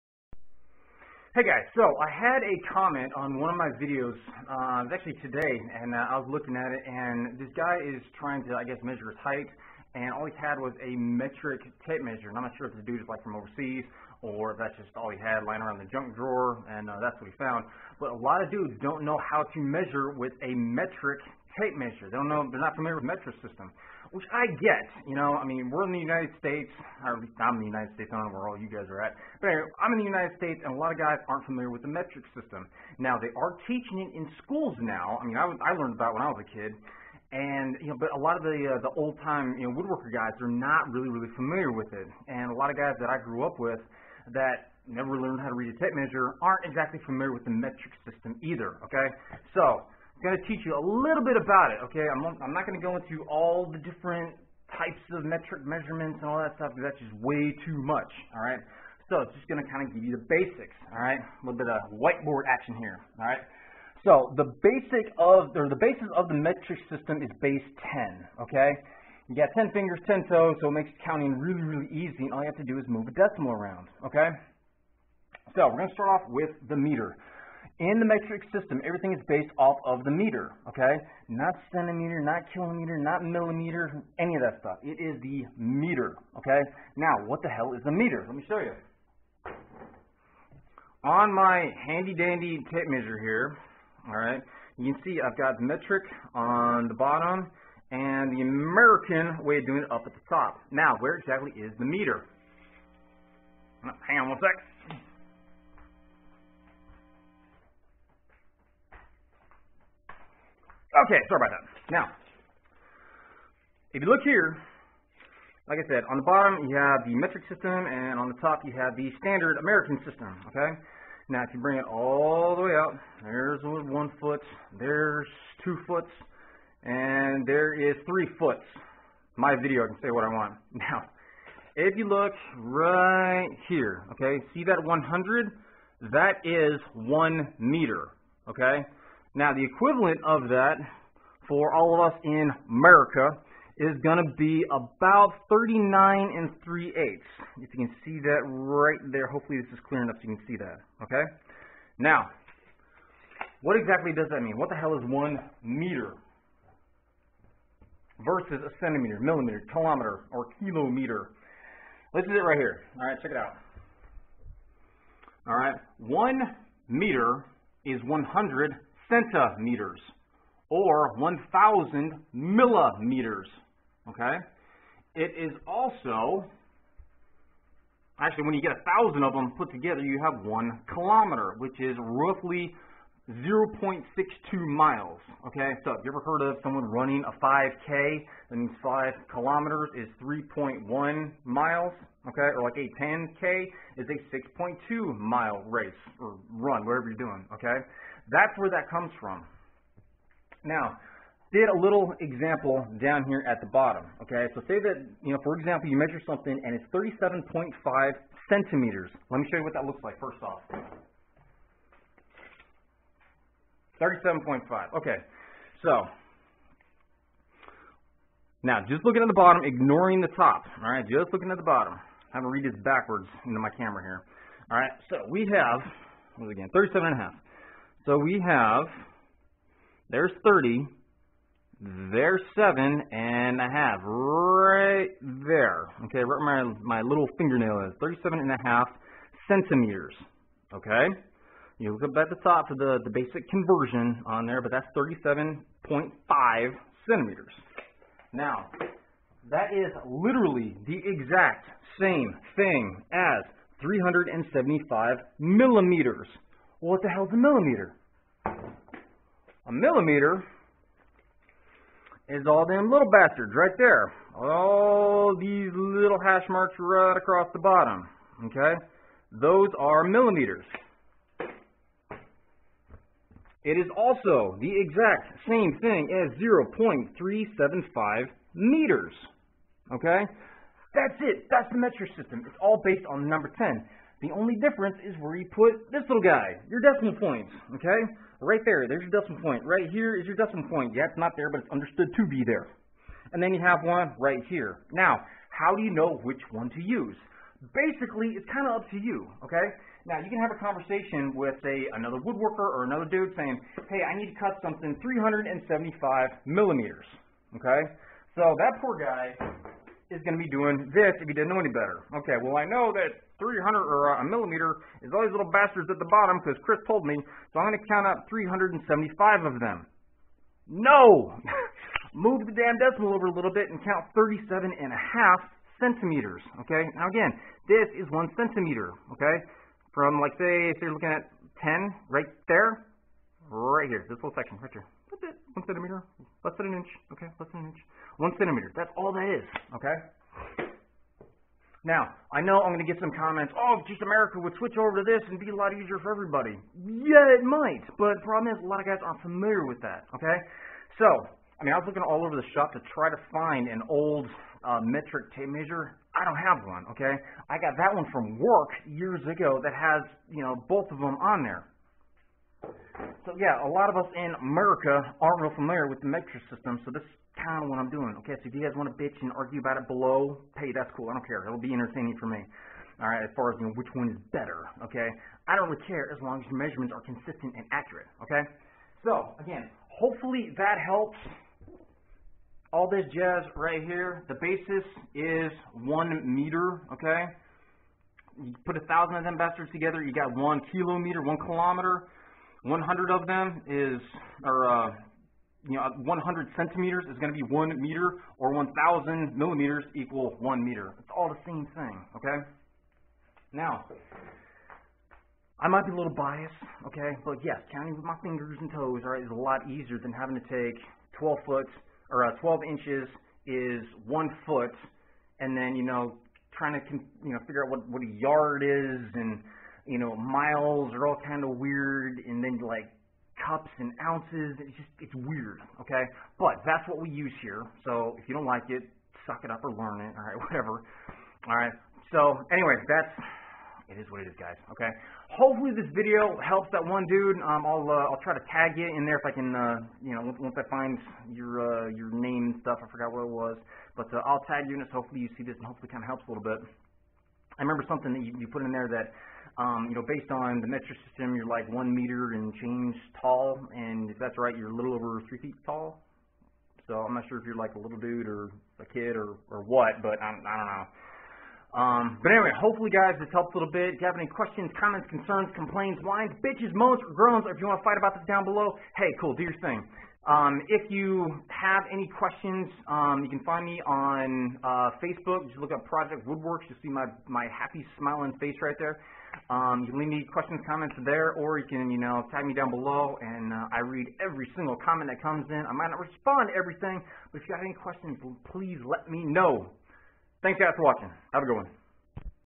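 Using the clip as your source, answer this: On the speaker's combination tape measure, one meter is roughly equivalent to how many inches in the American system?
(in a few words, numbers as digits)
39 3/8.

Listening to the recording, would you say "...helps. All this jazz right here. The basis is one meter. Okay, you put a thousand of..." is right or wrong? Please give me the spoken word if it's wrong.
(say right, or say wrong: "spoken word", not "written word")
right.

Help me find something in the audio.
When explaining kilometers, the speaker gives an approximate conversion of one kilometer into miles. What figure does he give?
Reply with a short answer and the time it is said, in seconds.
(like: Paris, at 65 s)
0.62 miles, at 183 s.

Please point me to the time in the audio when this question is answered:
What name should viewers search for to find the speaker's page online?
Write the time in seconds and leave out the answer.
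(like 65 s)
475 s.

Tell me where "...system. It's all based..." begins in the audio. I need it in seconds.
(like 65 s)
282 s.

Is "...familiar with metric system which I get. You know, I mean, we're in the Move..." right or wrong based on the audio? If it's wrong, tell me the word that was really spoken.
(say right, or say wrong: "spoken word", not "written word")
wrong: "United", not "Move".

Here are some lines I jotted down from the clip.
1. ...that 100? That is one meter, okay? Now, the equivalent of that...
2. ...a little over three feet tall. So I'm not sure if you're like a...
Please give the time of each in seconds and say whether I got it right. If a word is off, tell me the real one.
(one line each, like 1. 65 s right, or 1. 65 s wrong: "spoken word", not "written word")
1. 134 s right
2. 454 s right.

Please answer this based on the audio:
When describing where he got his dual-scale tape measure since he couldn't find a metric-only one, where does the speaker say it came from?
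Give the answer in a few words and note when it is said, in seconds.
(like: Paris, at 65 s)
work, at 358 s.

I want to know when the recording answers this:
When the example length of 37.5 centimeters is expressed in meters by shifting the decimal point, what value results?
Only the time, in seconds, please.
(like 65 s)
276 s.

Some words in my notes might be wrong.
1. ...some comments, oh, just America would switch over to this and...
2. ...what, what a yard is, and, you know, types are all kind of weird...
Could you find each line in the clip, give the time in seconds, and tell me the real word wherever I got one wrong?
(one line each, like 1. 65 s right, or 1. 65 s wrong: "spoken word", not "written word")
1. 343 s right
2. 417 s wrong: "miles", not "types".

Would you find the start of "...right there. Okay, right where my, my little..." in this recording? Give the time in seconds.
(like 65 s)
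234 s.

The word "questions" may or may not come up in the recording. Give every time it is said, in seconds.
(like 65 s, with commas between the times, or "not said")
464 s, 472 s, 480 s, 487 s.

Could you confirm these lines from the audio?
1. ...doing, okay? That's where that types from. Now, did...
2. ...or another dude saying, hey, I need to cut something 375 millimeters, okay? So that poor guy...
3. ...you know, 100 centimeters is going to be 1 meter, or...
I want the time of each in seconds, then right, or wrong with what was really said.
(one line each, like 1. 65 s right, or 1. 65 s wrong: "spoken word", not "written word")
1. 197 s wrong: "comes", not "types"
2. 302 s right
3. 395 s right.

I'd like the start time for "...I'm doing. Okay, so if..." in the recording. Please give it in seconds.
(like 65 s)
367 s.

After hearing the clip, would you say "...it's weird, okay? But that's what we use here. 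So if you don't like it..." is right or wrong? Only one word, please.
right.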